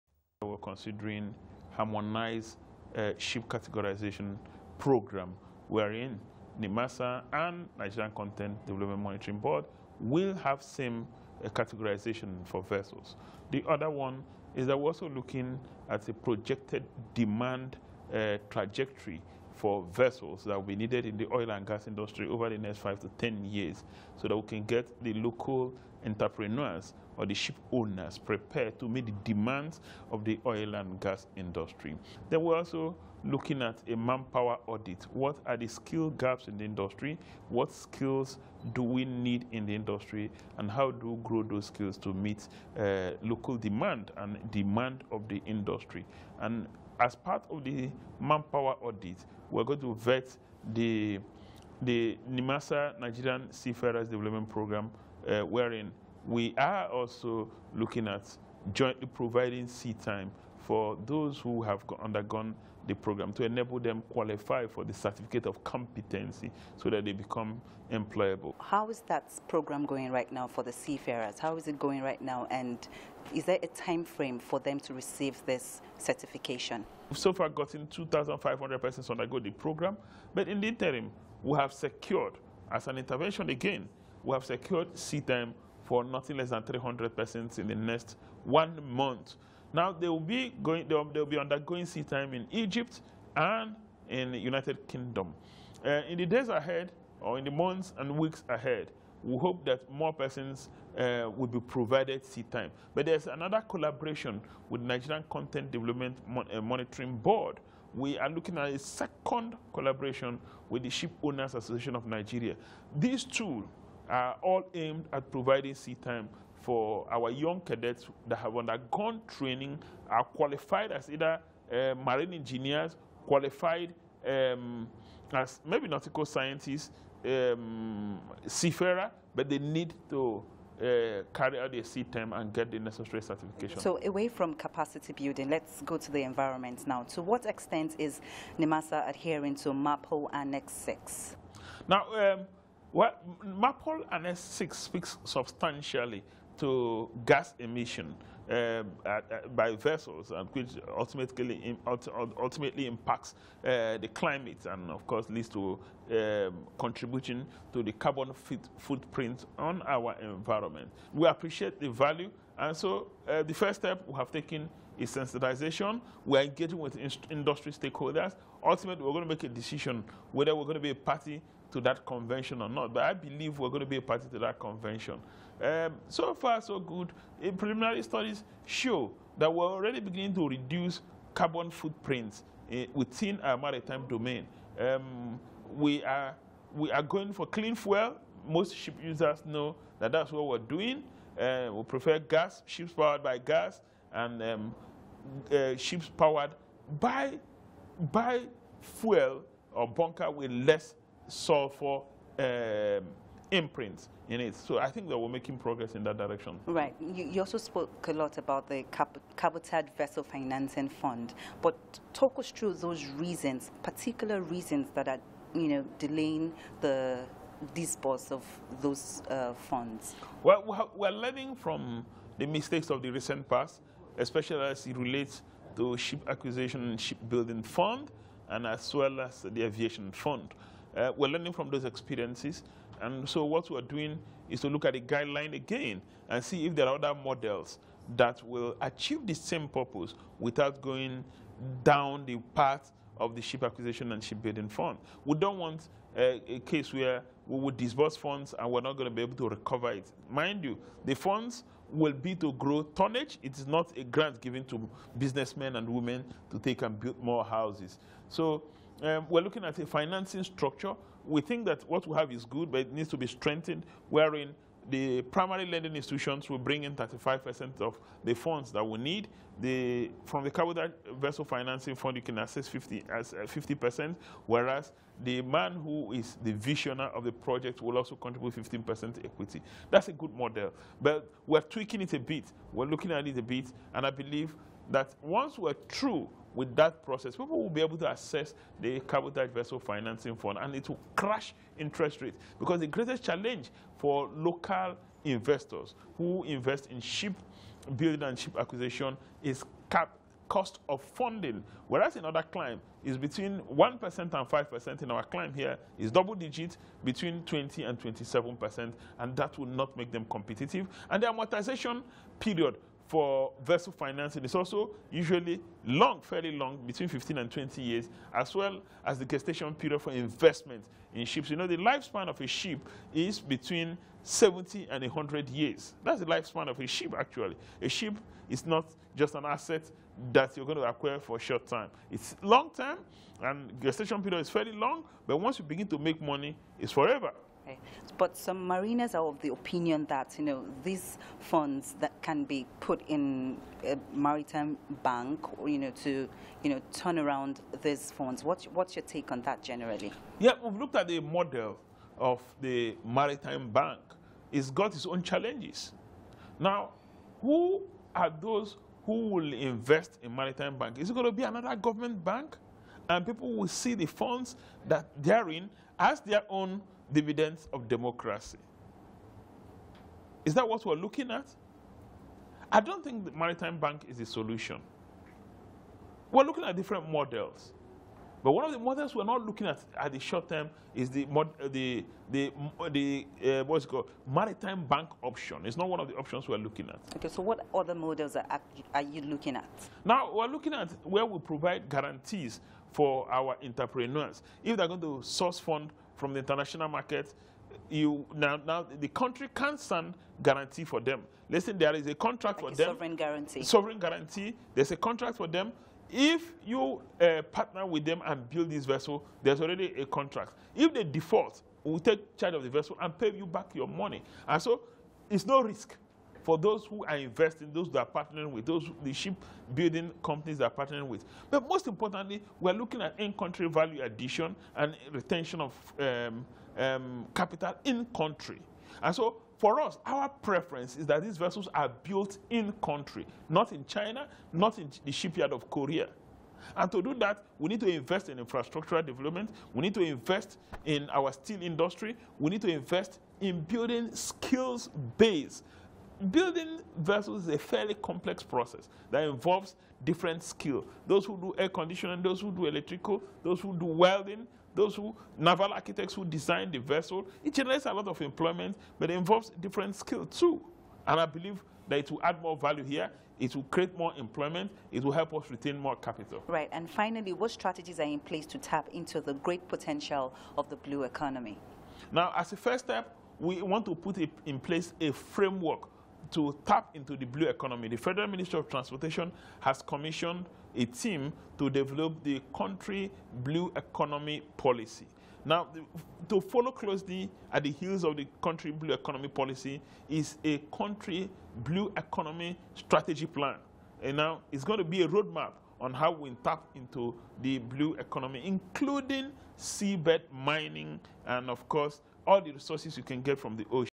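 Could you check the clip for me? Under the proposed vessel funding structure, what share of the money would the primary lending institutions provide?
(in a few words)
35%.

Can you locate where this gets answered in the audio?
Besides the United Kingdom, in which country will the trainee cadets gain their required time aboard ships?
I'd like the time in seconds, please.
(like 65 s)
92 s.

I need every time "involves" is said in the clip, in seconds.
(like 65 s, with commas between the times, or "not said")
449 s, 459 s.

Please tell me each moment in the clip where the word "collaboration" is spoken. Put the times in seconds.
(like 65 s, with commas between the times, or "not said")
103 s, 109 s.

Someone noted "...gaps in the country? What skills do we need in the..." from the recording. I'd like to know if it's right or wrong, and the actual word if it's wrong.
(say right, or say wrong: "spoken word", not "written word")
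wrong: "industry", not "country".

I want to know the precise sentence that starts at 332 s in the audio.
It's long term, and gestation period is fairly long, but once you begin to make money, it's forever.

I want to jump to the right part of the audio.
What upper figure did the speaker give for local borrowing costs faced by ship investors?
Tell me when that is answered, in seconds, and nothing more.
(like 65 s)
307 s.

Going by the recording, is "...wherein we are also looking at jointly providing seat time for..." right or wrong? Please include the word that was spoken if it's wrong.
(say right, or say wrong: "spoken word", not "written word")
right.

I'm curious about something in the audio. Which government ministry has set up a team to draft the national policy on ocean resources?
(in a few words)
Federal Ministry of Transportation.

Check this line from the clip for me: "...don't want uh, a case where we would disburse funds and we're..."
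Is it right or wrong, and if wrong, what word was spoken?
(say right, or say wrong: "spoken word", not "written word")
right.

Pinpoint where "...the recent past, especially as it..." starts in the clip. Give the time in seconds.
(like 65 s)
223 s.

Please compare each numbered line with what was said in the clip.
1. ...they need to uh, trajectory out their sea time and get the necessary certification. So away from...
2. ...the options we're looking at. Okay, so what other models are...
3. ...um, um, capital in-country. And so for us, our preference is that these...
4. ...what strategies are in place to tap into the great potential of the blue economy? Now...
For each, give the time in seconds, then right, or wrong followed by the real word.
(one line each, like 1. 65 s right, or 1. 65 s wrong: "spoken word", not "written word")
1. 129 s wrong: "carry", not "trajectory"
2. 386 s right
3. 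425 s right
4. 467 s right.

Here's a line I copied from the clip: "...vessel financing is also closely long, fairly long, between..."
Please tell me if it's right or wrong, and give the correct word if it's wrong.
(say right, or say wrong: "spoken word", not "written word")
wrong: "usually", not "closely".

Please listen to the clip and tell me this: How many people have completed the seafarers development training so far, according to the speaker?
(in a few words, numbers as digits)
2,500.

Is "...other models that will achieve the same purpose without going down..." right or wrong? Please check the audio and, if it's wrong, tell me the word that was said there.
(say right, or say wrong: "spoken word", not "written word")
right.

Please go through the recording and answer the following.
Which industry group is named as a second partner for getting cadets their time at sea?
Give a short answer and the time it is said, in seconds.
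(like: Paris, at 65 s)
Ship Owners Association of Nigeria, at 110 s.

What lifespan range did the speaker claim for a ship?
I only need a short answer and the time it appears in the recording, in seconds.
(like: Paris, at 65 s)
70 to 100 years, at 323 s.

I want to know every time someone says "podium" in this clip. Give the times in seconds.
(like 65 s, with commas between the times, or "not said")
not said.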